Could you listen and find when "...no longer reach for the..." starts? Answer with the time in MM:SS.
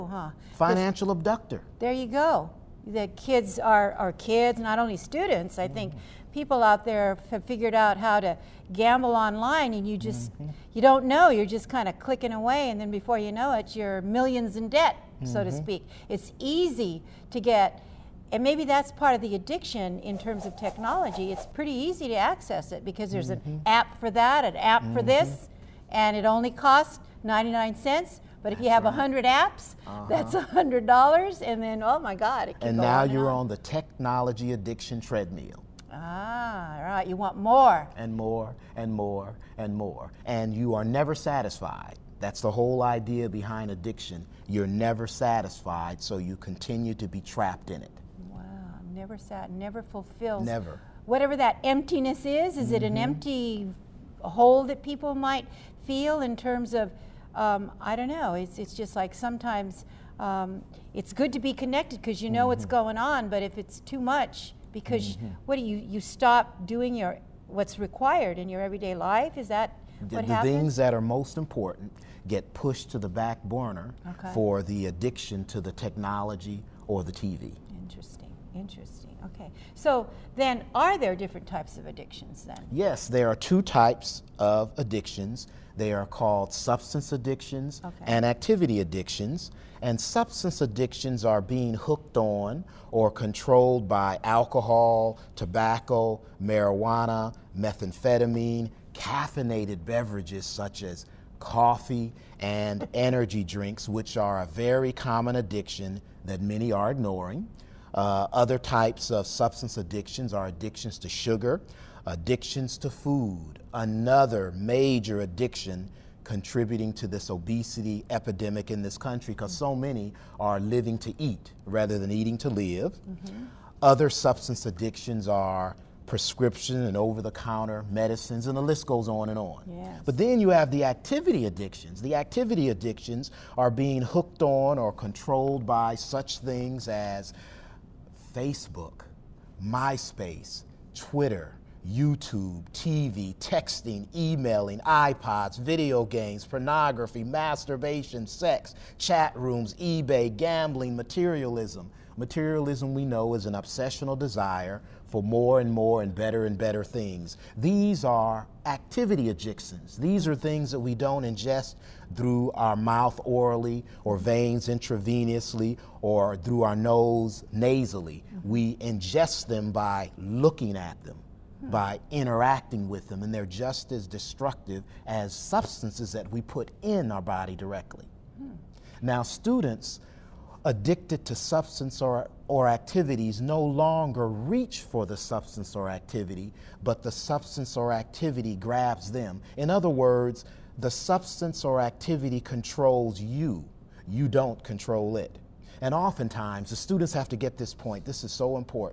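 03:03.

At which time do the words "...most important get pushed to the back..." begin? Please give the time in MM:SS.
01:11.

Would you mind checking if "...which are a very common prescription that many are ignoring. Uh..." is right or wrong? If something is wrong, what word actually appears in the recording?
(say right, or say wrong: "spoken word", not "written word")
wrong: "addiction", not "prescription".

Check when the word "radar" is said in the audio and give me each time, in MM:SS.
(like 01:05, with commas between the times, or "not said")
not said.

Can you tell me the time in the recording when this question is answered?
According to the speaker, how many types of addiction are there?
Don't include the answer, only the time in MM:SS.
01:23.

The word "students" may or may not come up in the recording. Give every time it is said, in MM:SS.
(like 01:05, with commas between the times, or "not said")
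00:04, 02:59, 03:16.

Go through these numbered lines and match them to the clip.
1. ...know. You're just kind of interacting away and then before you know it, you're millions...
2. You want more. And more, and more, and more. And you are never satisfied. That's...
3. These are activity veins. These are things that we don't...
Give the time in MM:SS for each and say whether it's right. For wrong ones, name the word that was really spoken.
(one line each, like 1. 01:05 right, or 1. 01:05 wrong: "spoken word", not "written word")
1. 00:11 wrong: "clicking", not "interacting"
2. 00:37 right
3. 02:37 wrong: "addictions", not "veins".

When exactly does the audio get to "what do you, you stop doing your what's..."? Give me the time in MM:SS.
01:05.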